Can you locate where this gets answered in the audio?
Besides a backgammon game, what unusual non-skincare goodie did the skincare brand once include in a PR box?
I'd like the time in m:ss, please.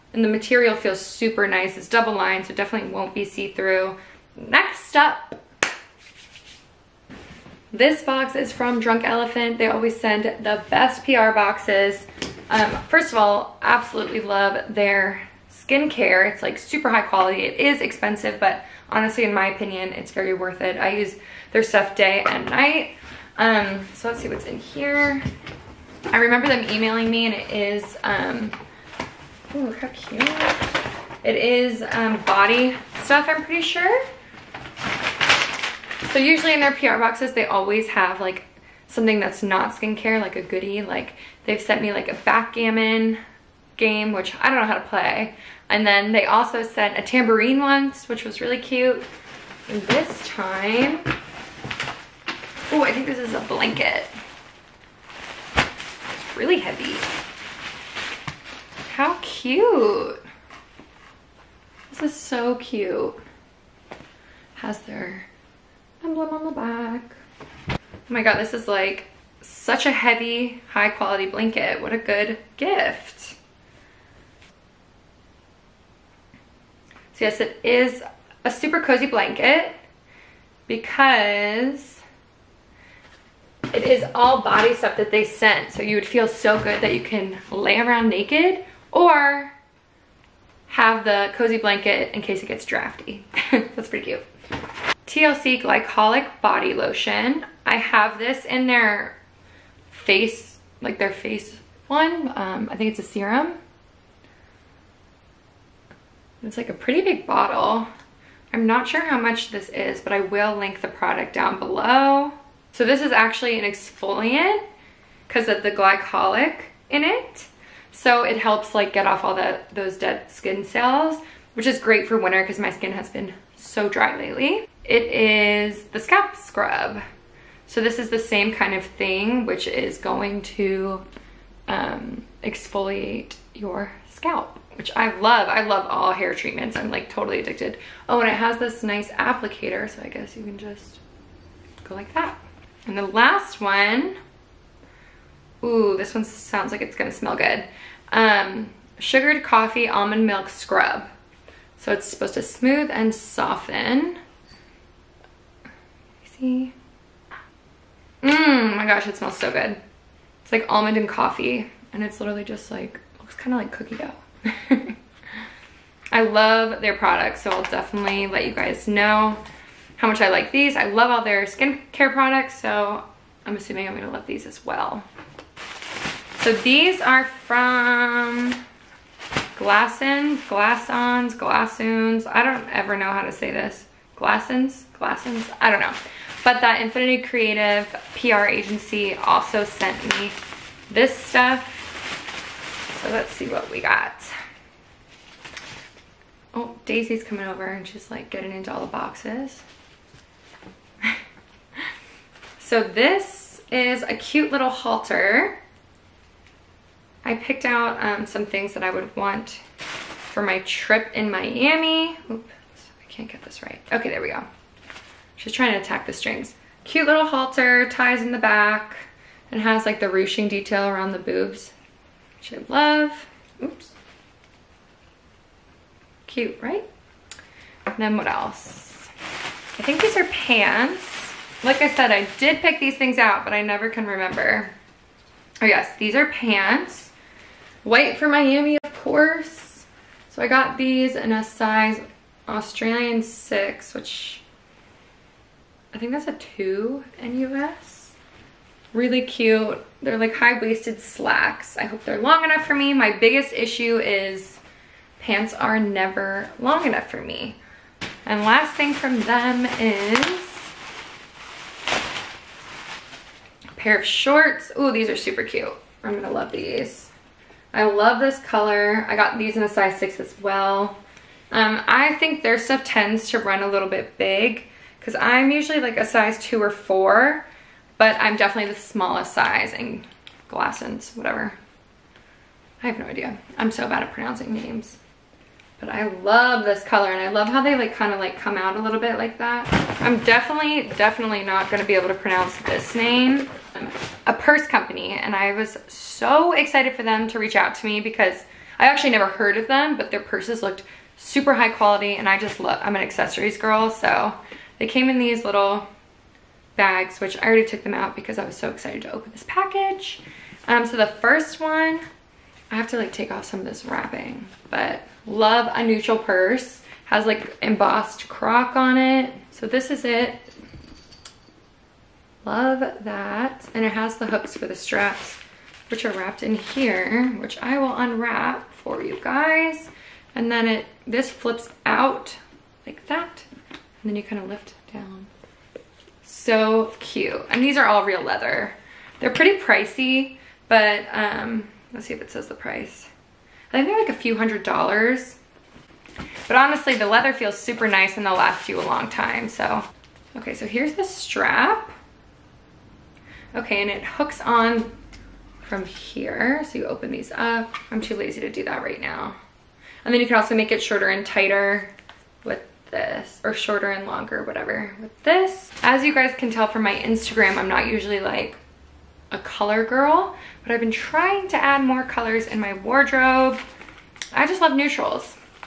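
0:47.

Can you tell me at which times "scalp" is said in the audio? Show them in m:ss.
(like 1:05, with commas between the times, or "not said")
2:05, 2:14.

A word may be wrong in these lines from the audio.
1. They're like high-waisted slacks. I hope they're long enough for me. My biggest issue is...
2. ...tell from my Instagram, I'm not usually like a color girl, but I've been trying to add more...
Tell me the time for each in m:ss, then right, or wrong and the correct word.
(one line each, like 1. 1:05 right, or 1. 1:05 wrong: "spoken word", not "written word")
1. 4:10 right
2. 6:06 right.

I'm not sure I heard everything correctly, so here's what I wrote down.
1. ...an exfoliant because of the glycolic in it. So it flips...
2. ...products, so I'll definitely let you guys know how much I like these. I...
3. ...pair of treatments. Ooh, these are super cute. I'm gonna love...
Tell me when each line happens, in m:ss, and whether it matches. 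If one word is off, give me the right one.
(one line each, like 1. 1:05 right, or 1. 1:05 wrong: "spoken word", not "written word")
1. 1:53 wrong: "helps", not "flips"
2. 2:46 right
3. 4:23 wrong: "shorts", not "treatments".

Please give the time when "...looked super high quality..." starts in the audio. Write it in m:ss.
5:00.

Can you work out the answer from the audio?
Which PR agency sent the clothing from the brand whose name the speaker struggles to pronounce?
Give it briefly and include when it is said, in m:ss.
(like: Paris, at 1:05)
Infinity Creative, at 3:06.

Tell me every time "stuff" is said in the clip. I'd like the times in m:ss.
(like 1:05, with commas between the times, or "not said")
0:21, 0:33, 1:24, 3:11, 4:32.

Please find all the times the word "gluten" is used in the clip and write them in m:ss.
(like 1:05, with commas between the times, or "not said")
not said.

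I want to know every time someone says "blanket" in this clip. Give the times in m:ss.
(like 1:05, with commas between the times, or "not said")
0:53, 1:11, 1:19, 1:31.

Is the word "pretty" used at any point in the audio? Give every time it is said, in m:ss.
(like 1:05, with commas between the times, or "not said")
0:33, 1:33, 1:46, 5:39.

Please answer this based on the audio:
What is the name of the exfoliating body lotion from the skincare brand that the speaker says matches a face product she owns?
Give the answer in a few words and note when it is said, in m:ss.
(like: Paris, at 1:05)
TLC Glycolic Body Lotion, at 1:35.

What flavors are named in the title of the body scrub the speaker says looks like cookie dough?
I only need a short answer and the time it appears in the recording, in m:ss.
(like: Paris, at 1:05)
sugared coffee almond milk, at 2:28.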